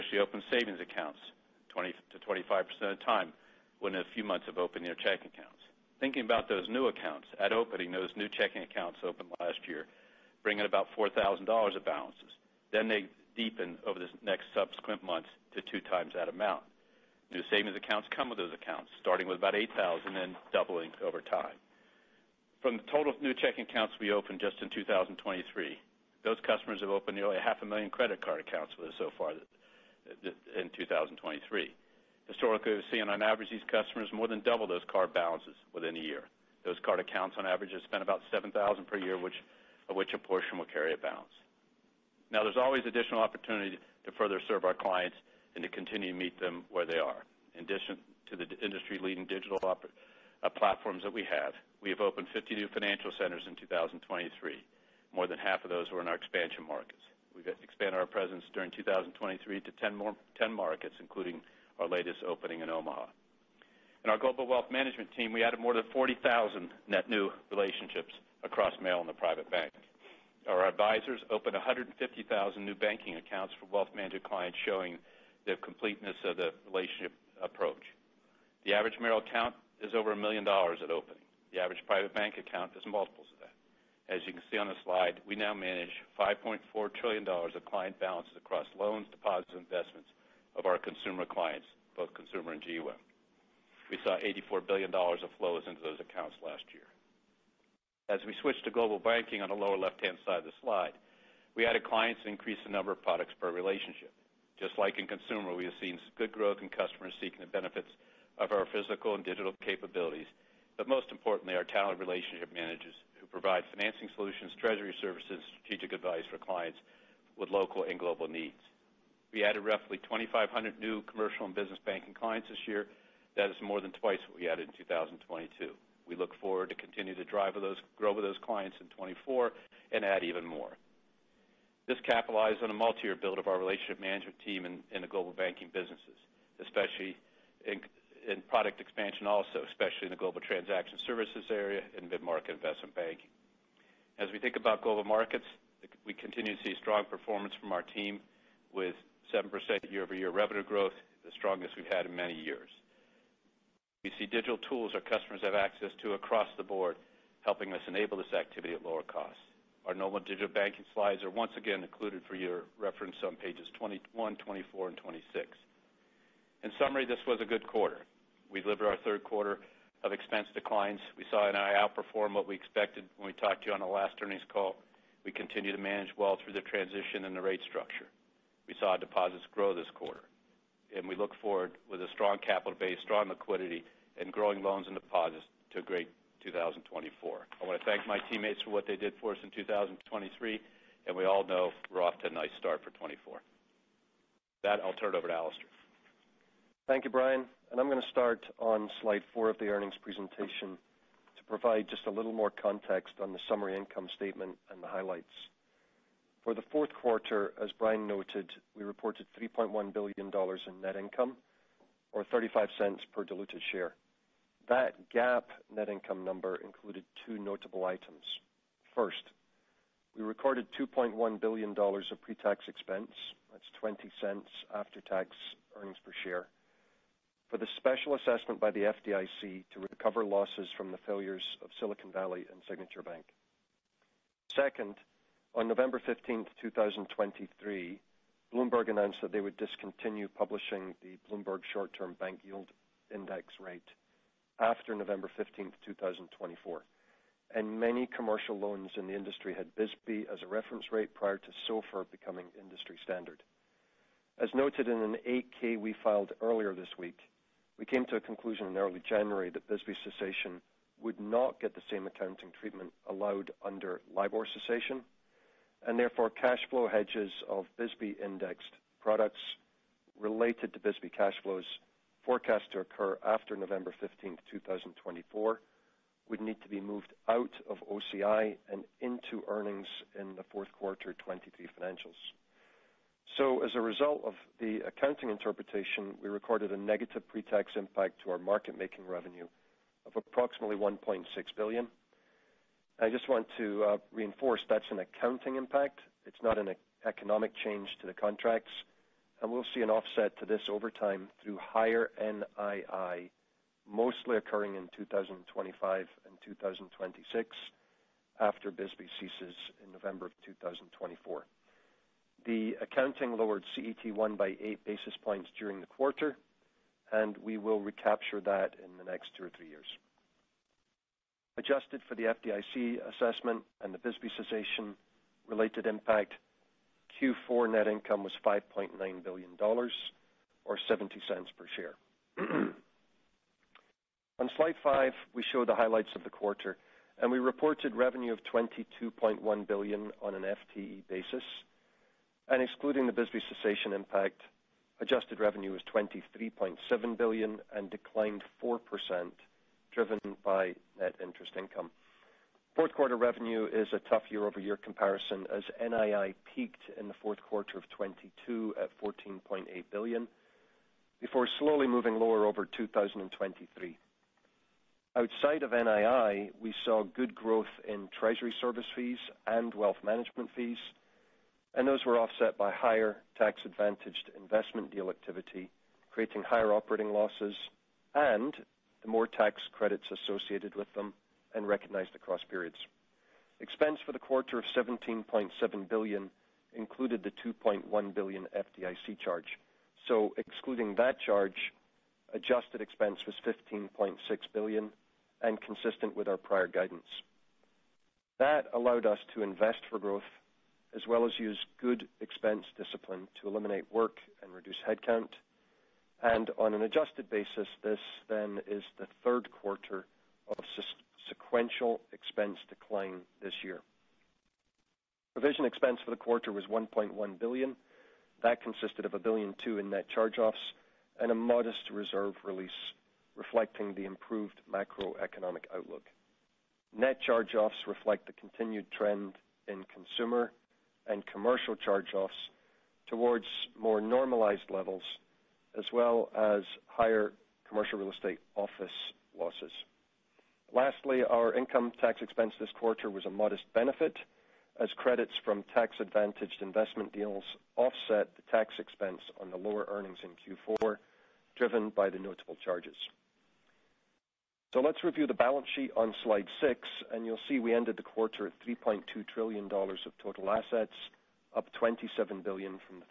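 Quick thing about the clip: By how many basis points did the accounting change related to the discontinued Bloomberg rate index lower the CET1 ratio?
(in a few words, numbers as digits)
8 basis points.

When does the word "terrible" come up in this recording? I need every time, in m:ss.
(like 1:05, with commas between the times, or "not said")
not said.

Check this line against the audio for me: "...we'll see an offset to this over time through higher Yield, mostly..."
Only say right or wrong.
wrong.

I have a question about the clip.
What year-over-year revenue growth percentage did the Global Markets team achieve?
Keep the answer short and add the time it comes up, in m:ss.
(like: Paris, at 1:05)
7%, at 2:29.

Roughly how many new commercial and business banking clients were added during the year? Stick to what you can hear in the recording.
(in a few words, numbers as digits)
2,500.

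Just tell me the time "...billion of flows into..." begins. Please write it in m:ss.
1:34.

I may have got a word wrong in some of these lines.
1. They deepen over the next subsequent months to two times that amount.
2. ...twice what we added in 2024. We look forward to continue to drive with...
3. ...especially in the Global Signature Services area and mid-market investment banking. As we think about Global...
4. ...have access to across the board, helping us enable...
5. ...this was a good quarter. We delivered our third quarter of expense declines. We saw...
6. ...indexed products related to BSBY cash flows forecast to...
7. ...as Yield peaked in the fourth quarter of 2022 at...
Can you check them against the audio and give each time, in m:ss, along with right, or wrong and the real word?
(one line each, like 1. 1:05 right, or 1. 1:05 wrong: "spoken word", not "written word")
1. 0:12 right
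2. 2:04 wrong: "2022", not "2024"
3. 2:19 wrong: "Transaction", not "Signature"
4. 2:35 right
5. 2:47 right
6. 4:28 right
7. 5:55 wrong: "NII", not "Yield".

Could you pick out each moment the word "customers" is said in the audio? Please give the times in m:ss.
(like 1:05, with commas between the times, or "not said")
0:26, 0:33, 1:46, 2:35.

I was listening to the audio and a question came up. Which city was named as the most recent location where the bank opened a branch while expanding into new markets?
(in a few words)
Omaha.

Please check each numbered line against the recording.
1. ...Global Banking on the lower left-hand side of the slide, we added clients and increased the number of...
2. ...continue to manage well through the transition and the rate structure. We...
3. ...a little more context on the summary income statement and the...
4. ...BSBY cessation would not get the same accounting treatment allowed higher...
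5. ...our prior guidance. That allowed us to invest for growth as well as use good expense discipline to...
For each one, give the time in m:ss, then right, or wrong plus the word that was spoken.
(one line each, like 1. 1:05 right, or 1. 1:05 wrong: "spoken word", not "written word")
1. 1:38 right
2. 2:55 right
3. 3:22 right
4. 4:19 wrong: "under", not "higher"
5. 6:36 right.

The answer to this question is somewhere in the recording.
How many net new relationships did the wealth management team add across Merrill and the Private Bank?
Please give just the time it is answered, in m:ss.
1:05.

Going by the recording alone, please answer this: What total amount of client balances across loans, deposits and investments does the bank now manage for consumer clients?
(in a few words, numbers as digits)
$5.4 trillion.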